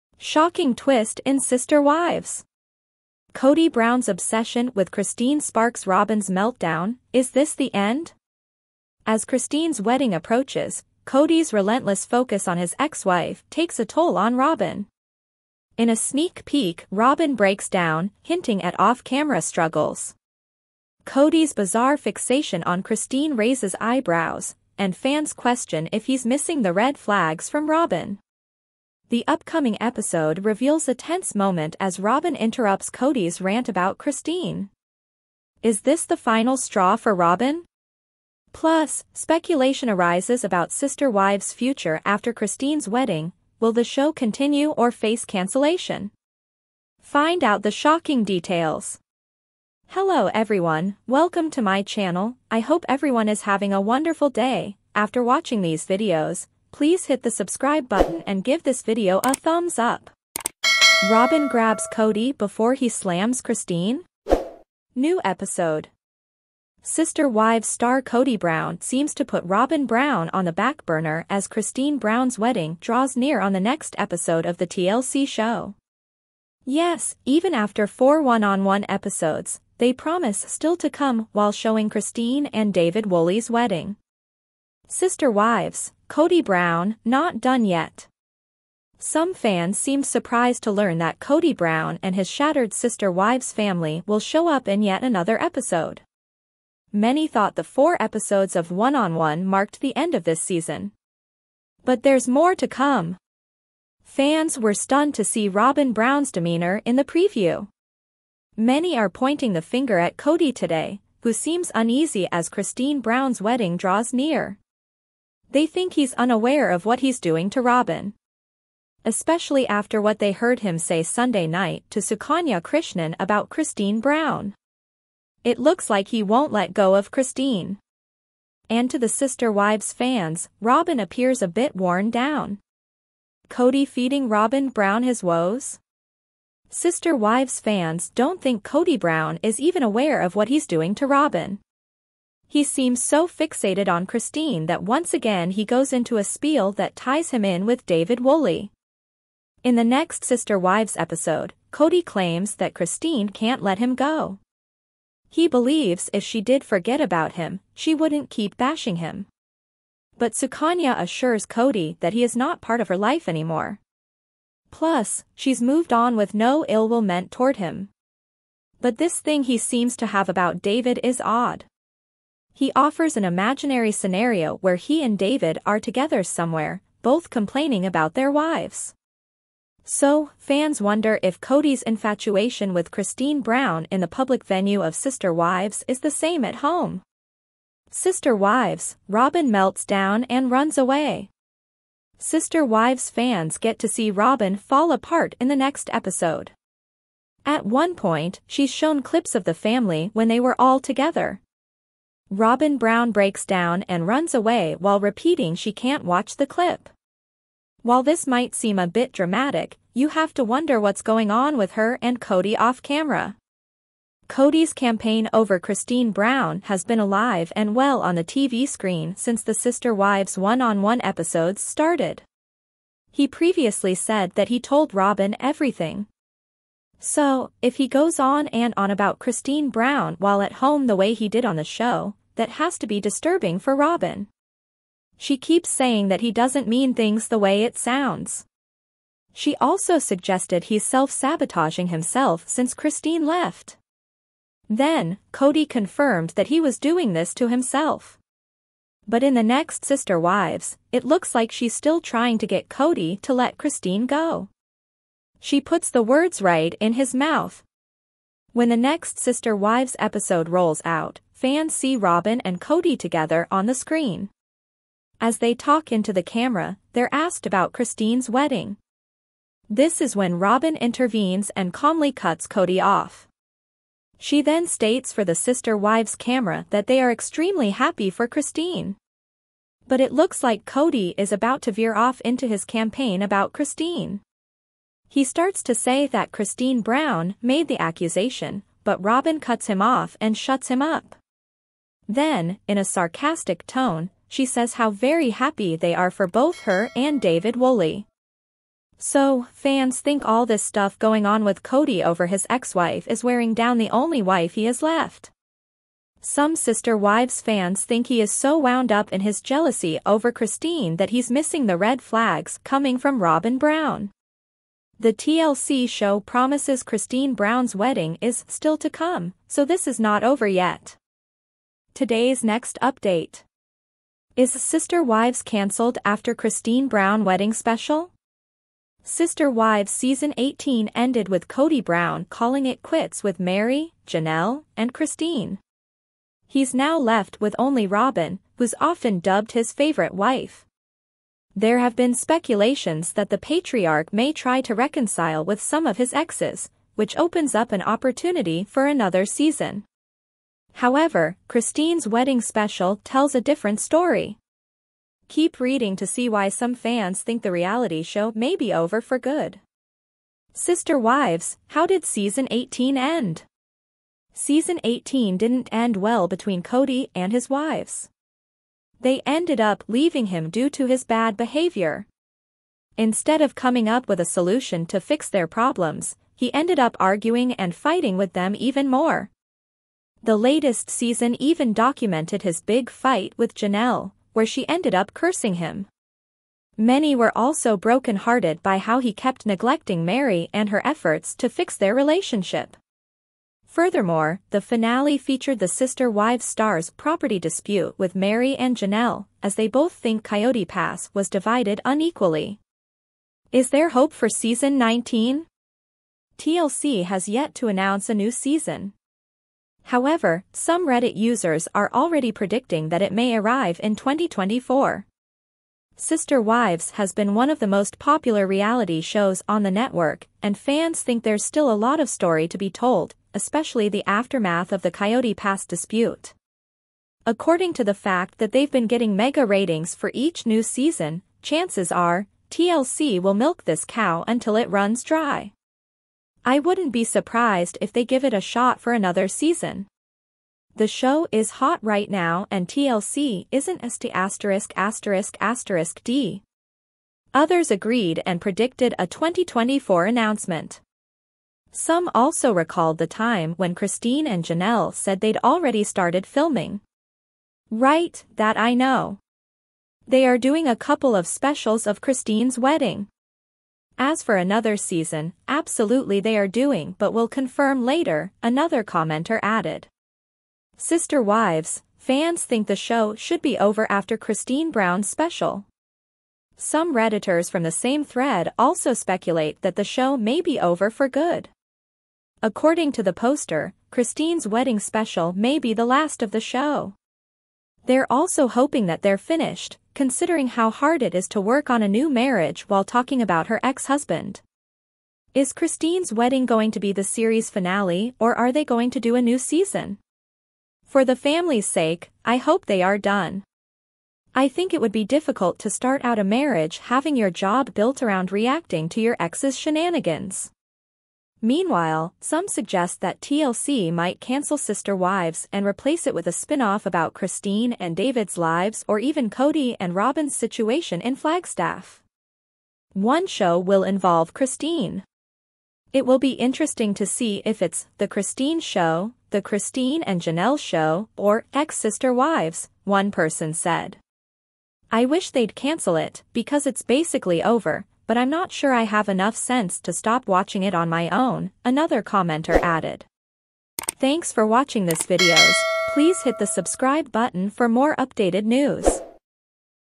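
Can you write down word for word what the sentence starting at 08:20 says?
For the family's sake, I hope they are done.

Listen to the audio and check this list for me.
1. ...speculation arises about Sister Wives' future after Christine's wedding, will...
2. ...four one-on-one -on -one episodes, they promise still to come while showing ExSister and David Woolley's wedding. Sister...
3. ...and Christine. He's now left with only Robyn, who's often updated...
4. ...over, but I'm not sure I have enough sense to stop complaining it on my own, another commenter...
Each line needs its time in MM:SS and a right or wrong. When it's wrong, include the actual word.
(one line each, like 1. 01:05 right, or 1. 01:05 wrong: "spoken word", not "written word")
1. 00:39 right
2. 01:17 wrong: "Christine", not "ExSister"
3. 05:34 wrong: "dubbed", not "updated"
4. 08:57 wrong: "watching", not "complaining".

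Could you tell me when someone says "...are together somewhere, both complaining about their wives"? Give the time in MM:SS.
02:55.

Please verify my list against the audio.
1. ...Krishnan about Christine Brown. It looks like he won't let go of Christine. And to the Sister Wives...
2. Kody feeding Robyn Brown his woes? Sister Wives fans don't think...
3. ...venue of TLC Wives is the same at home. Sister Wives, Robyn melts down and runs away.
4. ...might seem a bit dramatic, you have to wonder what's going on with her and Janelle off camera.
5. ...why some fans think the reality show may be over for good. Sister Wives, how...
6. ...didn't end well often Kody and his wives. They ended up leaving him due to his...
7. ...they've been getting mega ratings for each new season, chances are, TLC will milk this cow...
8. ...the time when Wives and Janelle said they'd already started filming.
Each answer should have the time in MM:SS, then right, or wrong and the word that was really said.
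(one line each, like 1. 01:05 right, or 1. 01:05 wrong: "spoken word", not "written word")
1. 02:02 right
2. 02:13 right
3. 03:04 wrong: "Sister", not "TLC"
4. 03:28 wrong: "Kody", not "Janelle"
5. 05:56 right
6. 06:05 wrong: "between", not "often"
7. 07:08 right
8. 07:32 wrong: "Christine", not "Wives".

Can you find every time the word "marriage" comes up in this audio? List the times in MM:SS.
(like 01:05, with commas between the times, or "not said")
08:12, 08:26.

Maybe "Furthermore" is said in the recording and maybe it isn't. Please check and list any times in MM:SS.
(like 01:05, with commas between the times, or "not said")
06:33.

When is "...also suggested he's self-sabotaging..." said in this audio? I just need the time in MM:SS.
03:59.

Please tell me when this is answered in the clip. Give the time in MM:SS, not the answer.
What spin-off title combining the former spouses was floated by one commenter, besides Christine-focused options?
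08:51.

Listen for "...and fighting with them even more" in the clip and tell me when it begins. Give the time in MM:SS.
06:17.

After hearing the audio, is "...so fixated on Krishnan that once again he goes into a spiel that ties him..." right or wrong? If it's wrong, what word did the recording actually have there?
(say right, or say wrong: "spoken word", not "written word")
wrong: "Christine", not "Krishnan".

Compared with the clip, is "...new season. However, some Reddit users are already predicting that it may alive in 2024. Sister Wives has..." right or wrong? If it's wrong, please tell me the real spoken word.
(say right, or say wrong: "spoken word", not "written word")
wrong: "arrive", not "alive".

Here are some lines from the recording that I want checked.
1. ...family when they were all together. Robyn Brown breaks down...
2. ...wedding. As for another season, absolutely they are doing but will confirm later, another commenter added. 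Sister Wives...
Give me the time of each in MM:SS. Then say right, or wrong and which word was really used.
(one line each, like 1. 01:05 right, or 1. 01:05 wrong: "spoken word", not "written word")
1. 03:19 right
2. 07:42 right.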